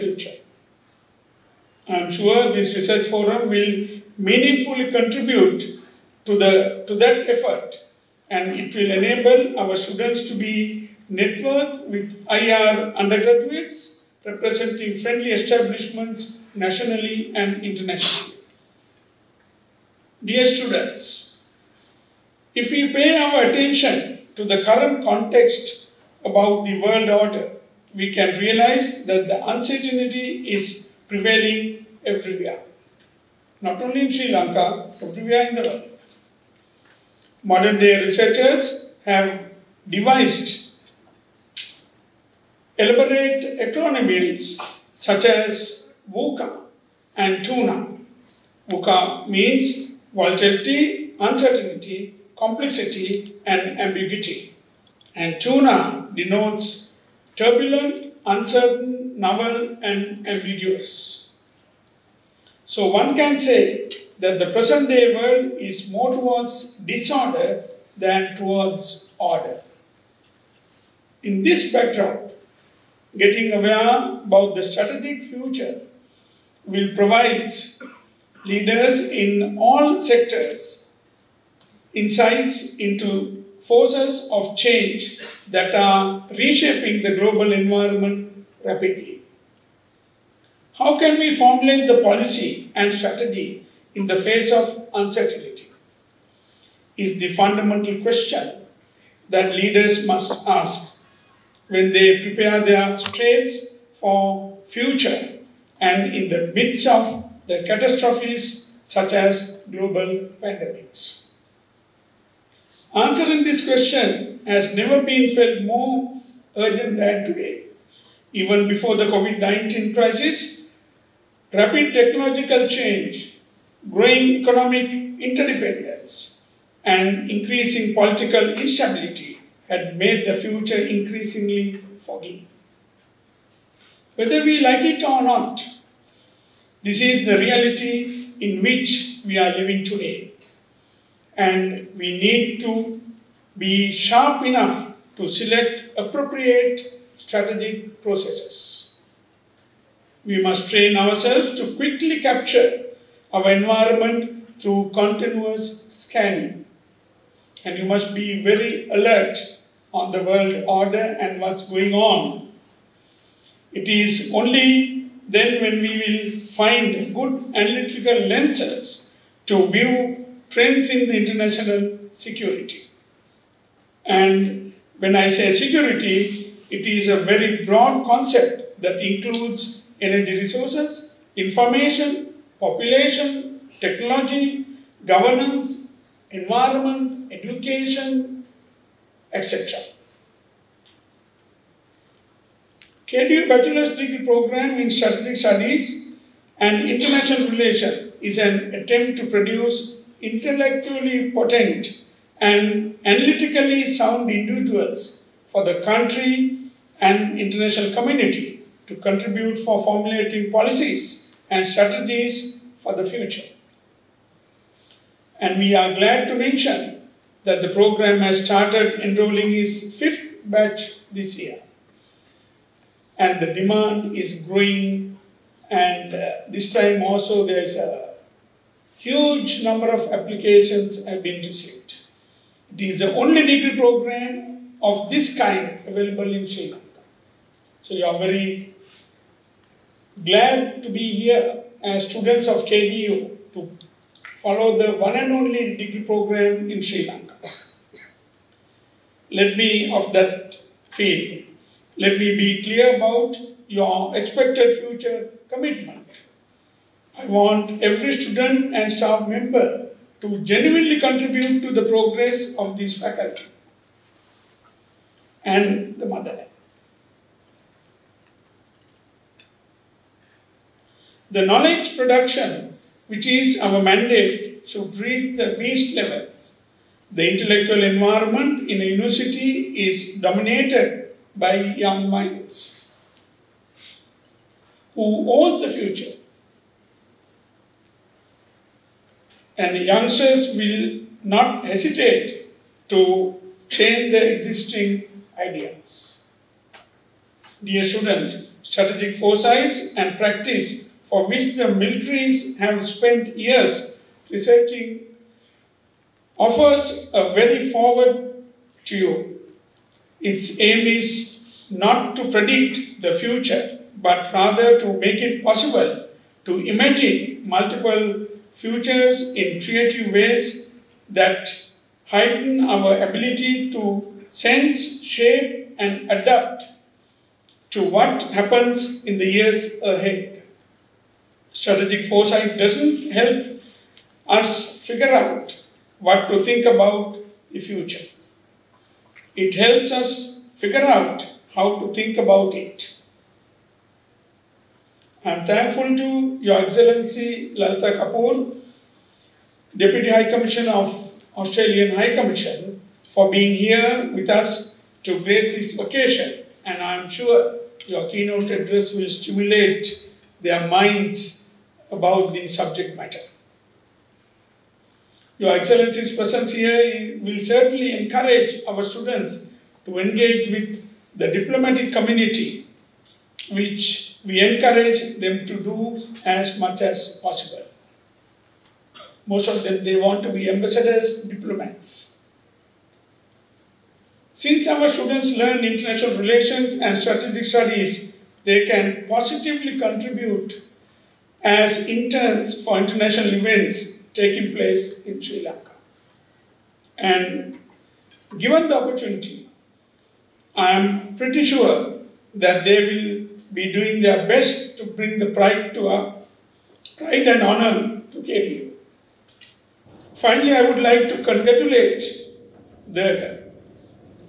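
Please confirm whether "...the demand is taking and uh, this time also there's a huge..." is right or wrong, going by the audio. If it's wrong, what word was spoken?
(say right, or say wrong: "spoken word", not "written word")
wrong: "growing", not "taking".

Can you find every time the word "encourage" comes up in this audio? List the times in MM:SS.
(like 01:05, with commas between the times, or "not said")
06:08, 06:14.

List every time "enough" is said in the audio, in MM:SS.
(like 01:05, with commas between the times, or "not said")
02:24.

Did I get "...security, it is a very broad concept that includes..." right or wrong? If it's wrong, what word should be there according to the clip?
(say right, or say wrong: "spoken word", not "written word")
right.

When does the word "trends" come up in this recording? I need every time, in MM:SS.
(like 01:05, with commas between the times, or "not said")
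02:50.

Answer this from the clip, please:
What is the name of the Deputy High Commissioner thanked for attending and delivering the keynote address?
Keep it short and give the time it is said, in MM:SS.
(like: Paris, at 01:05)
Lalita Kapoor, at 05:47.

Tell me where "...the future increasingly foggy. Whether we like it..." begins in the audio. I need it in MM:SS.
02:10.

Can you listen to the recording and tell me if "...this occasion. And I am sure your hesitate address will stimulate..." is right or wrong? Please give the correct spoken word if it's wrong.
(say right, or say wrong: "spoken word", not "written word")
wrong: "keynote", not "hesitate".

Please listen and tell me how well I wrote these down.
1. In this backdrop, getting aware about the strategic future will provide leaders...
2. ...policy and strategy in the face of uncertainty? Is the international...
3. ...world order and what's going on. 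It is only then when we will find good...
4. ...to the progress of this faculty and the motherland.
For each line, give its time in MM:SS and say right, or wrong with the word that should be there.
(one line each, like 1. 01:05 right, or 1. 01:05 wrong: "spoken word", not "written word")
1. 01:11 right
2. 01:32 wrong: "fundamental", not "international"
3. 02:40 right
4. 04:21 right.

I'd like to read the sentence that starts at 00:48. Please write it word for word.
VUCA means volatility, uncertainty, complexity, and ambiguity.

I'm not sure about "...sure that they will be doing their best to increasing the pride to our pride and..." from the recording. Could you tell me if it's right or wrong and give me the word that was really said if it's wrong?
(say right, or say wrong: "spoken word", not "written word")
wrong: "bring", not "increasing".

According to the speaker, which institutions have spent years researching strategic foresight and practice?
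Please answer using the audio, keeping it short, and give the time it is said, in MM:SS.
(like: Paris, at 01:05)
Militaries, at 05:01.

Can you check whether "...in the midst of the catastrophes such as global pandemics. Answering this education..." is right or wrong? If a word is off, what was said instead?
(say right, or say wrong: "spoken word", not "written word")
wrong: "question", not "education".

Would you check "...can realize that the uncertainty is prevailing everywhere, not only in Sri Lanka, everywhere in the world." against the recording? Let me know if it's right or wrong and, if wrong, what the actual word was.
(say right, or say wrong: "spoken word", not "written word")
right.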